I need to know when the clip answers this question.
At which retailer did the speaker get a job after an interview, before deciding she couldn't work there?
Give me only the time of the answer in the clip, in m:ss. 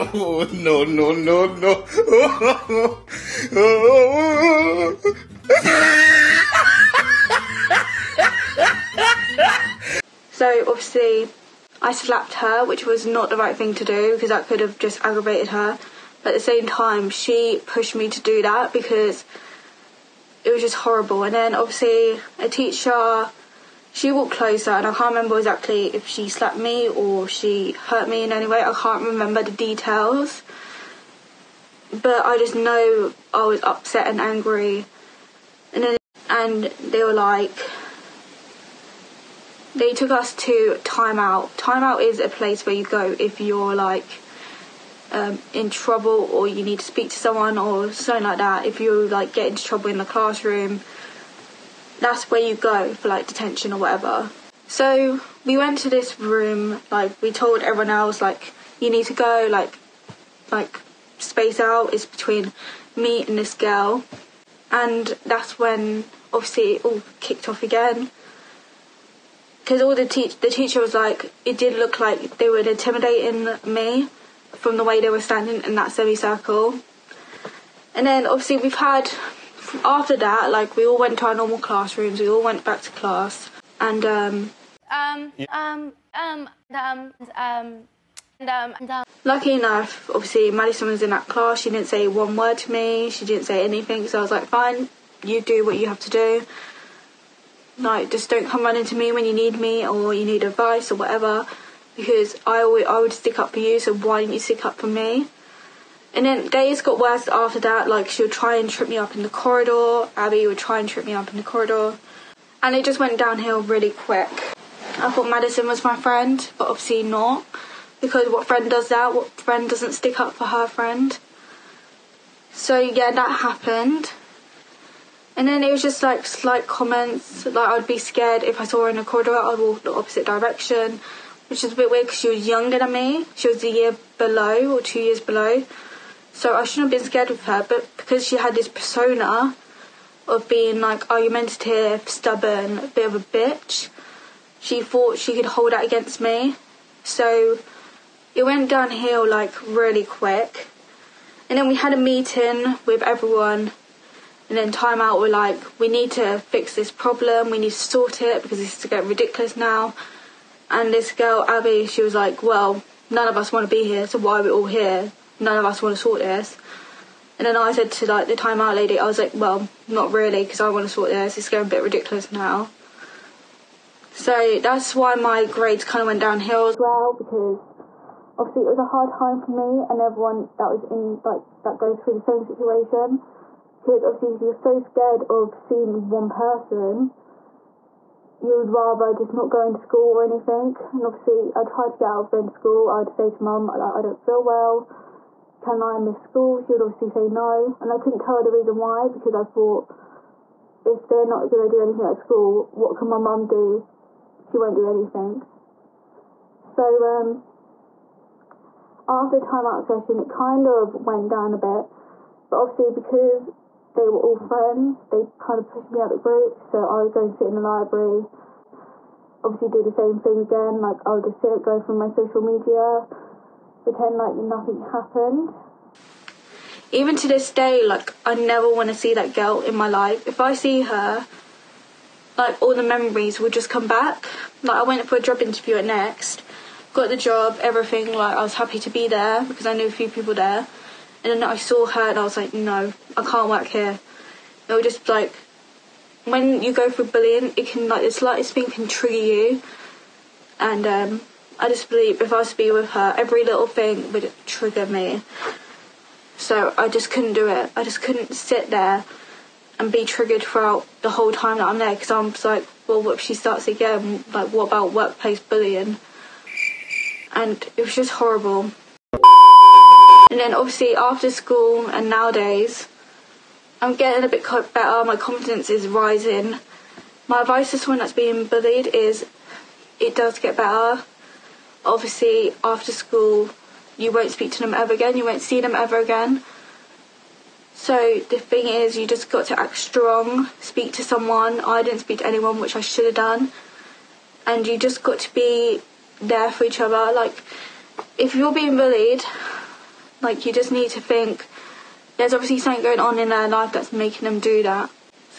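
3:55.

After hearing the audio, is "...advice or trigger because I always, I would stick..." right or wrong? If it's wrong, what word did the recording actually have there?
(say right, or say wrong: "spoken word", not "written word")
wrong: "whatever", not "trigger".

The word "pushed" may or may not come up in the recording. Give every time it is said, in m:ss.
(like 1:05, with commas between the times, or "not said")
0:17, 3:35.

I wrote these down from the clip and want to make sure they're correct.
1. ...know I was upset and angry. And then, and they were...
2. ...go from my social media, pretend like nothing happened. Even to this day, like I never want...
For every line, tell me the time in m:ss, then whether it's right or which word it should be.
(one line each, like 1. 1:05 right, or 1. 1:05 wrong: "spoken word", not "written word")
1. 0:32 right
2. 3:41 right.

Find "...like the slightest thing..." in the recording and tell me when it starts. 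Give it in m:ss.
4:07.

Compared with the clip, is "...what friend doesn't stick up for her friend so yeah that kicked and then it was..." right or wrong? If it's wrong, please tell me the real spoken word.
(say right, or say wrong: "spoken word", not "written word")
wrong: "happened", not "kicked".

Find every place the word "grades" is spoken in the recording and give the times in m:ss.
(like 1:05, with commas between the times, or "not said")
2:55.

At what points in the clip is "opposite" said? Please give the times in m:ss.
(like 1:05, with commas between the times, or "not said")
2:09.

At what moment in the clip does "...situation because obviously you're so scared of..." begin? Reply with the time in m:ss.
3:02.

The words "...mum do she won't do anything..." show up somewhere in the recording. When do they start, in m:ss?
3:23.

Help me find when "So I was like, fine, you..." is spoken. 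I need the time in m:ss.
1:34.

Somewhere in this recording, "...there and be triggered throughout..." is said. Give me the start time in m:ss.
4:18.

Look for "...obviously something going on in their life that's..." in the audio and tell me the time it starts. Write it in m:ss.
5:02.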